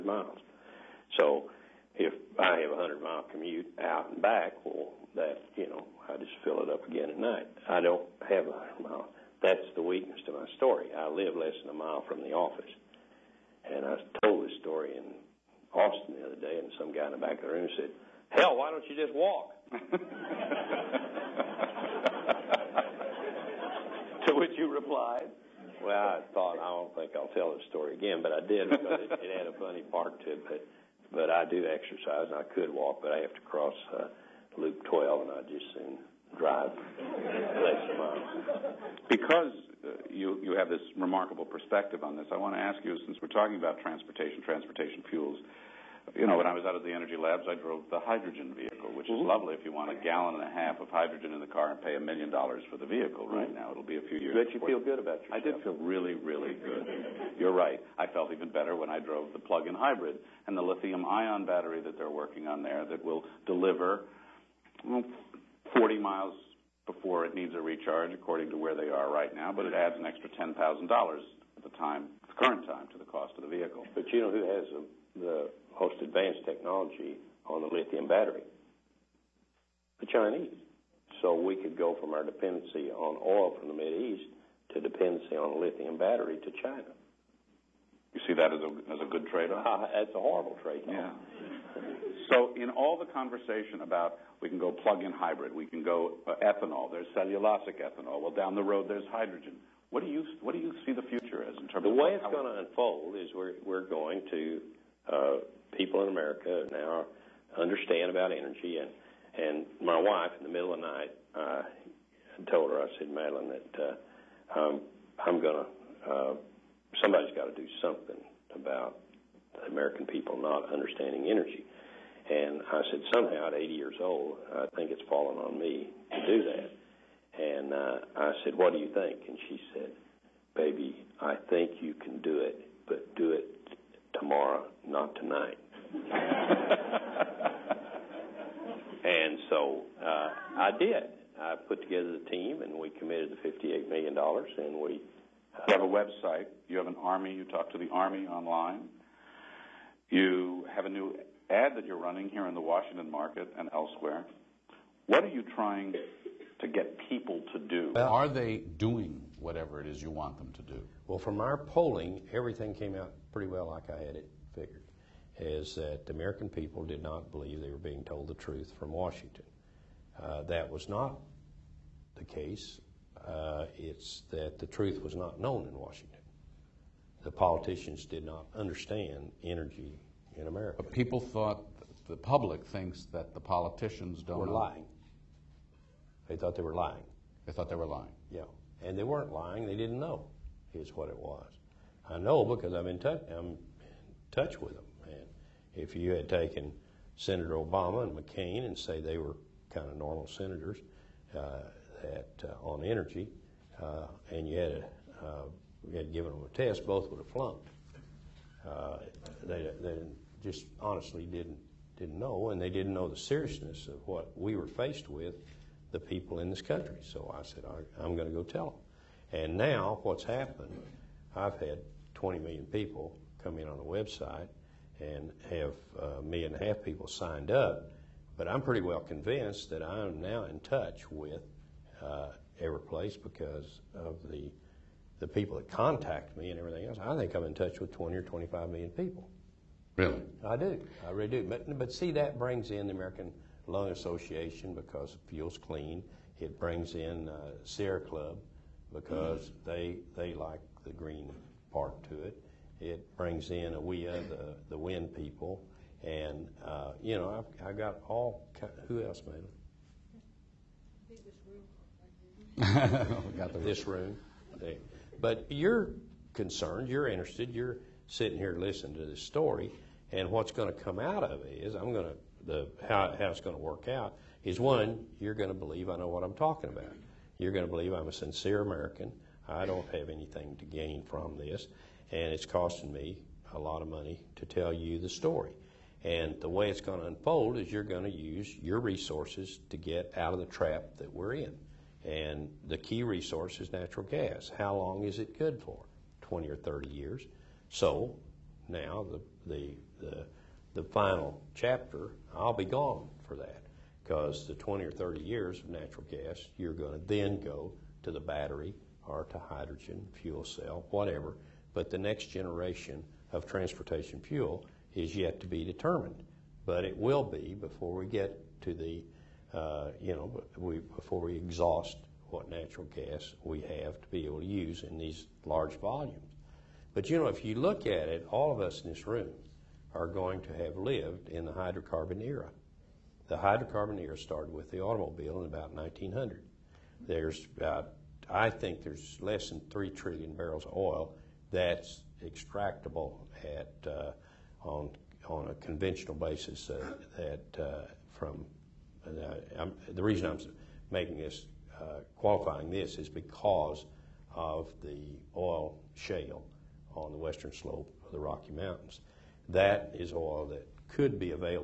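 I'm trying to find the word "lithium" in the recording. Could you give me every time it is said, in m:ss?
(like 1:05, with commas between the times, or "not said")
1:00, 1:17, 1:25.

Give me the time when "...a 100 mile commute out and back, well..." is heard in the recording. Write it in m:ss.
0:02.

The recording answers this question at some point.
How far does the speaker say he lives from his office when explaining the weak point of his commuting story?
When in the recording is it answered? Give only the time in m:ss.
0:11.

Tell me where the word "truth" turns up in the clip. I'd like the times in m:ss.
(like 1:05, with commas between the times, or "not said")
2:48, 2:54.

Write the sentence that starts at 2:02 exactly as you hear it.
And I said, somehow at 80 years old, I think it's fallen on me to do that.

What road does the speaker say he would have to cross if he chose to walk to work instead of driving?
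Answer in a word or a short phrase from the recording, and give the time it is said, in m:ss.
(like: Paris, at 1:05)
Loop 12, at 0:34.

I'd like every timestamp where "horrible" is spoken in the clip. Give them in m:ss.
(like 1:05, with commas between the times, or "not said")
1:30.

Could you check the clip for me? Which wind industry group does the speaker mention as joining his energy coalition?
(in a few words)
AWEA.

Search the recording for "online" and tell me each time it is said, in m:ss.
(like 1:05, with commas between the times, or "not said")
2:28.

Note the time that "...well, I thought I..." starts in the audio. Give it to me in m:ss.
0:25.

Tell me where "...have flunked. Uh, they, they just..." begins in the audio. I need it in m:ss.
3:27.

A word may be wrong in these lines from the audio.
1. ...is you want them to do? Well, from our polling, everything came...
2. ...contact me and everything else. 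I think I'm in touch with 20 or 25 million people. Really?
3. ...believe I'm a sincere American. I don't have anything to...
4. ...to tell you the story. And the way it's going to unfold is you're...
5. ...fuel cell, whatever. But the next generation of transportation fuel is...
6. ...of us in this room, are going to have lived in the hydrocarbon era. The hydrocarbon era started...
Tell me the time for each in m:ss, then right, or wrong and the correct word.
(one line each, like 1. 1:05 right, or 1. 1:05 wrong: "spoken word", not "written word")
1. 2:39 right
2. 3:55 right
3. 4:37 right
4. 4:44 right
5. 5:10 right
6. 5:28 right.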